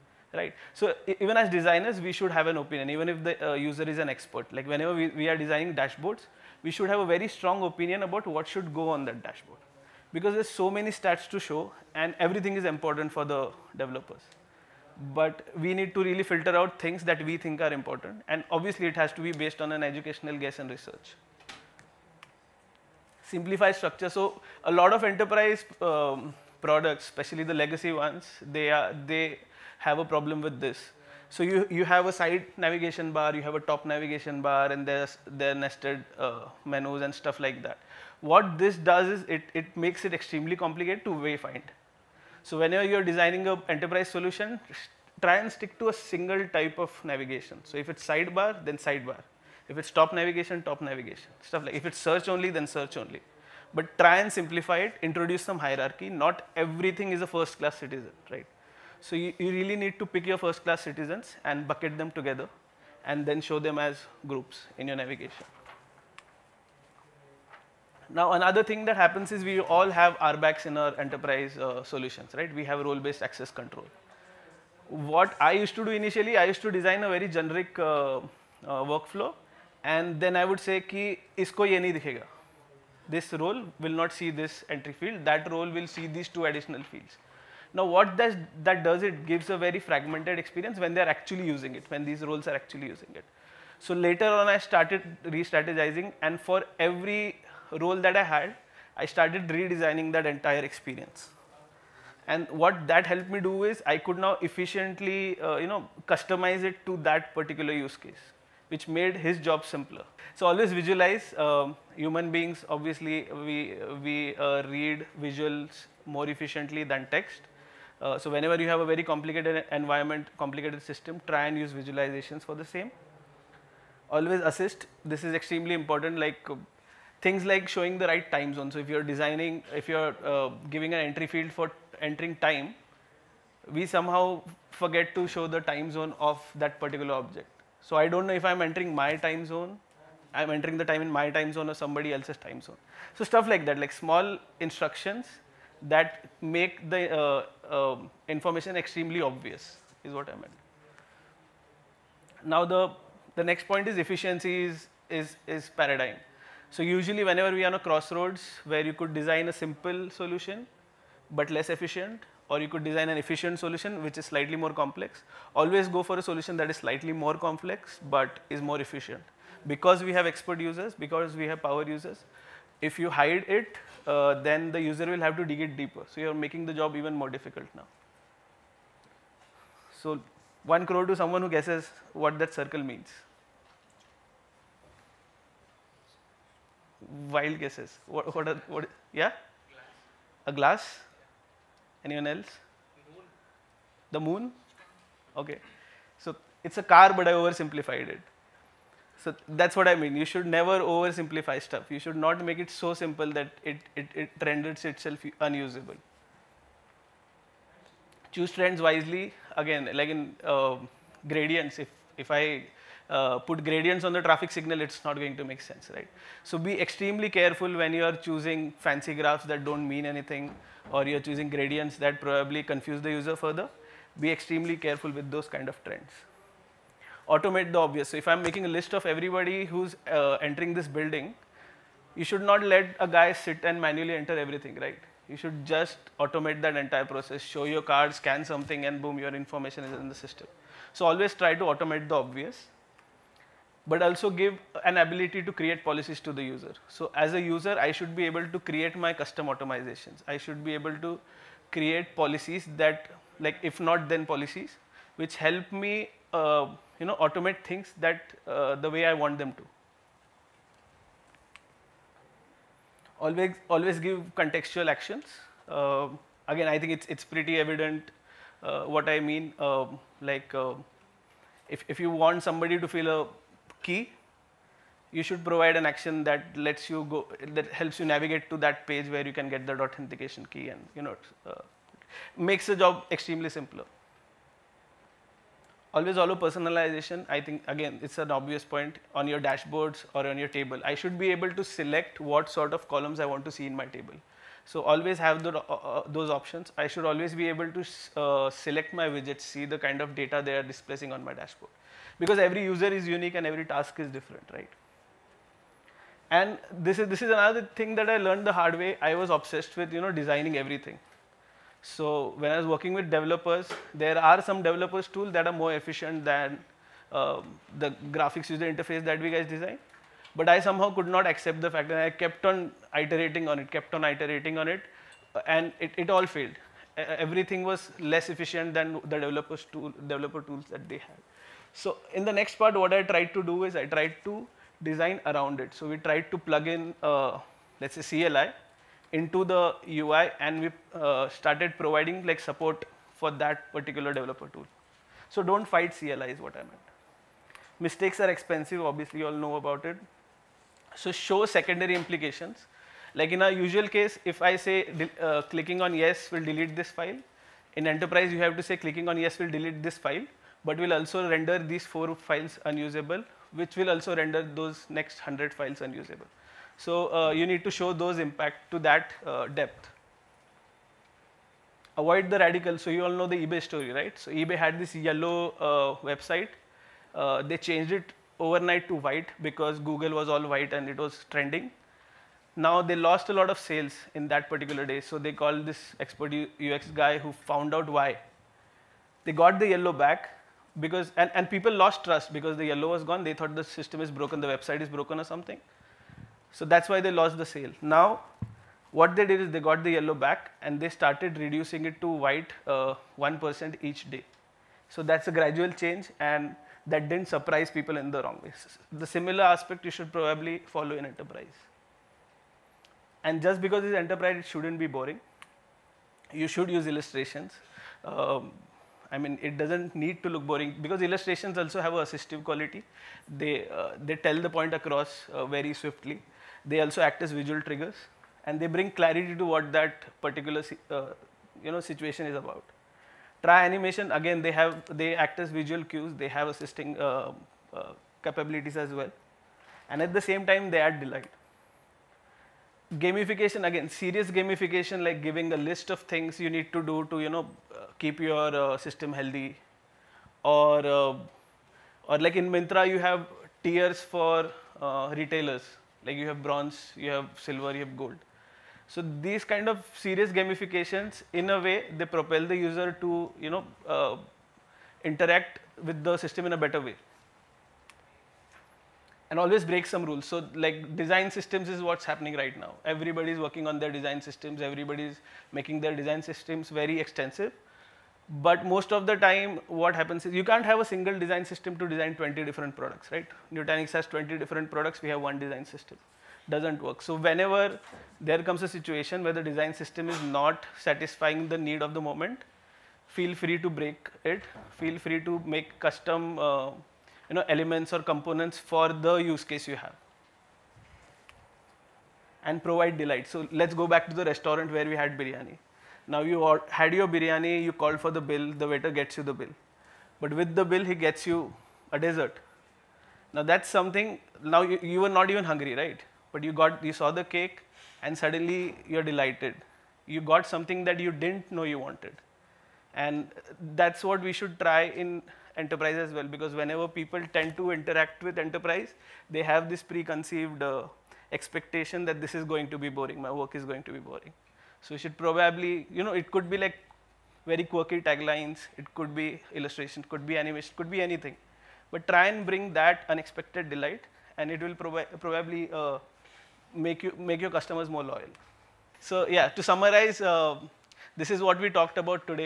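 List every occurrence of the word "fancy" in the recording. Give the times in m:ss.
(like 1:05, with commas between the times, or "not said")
3:38.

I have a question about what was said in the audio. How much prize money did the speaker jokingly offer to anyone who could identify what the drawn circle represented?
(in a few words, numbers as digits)
1 crore.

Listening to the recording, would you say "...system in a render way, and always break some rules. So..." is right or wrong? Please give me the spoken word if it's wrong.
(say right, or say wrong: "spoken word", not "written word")
wrong: "better", not "render".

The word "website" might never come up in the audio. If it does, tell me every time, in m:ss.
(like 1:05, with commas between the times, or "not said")
6:16, 6:34.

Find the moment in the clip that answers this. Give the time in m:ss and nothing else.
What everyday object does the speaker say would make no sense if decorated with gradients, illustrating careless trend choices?
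3:34.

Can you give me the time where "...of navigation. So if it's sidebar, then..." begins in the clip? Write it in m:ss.
0:46.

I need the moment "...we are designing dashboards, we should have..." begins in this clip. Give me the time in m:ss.
0:05.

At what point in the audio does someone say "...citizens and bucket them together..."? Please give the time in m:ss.
1:00.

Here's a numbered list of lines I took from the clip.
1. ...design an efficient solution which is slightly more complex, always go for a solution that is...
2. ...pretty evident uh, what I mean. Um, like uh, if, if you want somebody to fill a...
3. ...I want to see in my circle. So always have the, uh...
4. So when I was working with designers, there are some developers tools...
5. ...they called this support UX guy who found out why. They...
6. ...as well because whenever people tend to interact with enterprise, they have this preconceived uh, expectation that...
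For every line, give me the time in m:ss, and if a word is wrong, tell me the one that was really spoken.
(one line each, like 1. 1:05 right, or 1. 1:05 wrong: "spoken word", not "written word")
1. 2:42 right
2. 4:27 right
3. 4:53 wrong: "table", not "circle"
4. 5:11 wrong: "developers", not "designers"
5. 6:25 wrong: "expert", not "support"
6. 8:45 right.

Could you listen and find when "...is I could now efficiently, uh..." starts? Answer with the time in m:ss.
1:43.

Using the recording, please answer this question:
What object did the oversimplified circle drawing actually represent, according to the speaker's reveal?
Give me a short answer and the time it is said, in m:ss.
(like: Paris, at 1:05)
A car, at 3:16.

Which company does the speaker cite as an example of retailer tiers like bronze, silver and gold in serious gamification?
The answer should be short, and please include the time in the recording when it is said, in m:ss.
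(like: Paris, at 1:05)
Myntra, at 7:32.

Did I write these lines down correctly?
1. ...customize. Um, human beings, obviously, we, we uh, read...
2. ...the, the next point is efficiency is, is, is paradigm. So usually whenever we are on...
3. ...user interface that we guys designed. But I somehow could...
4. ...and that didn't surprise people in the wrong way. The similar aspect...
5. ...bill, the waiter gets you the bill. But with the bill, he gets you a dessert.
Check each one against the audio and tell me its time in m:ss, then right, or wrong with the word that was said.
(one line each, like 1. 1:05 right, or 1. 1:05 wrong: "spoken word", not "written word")
1. 1:50 wrong: "visualize", not "customize"
2. 2:32 right
3. 5:18 right
4. 6:46 right
5. 8:28 right.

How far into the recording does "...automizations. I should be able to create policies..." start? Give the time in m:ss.
4:09.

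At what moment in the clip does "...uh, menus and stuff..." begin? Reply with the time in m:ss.
0:36.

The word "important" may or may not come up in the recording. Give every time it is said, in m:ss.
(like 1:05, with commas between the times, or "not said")
0:12, 0:17, 2:05.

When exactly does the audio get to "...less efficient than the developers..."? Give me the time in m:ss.
5:28.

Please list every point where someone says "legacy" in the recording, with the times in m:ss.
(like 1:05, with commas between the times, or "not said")
0:27.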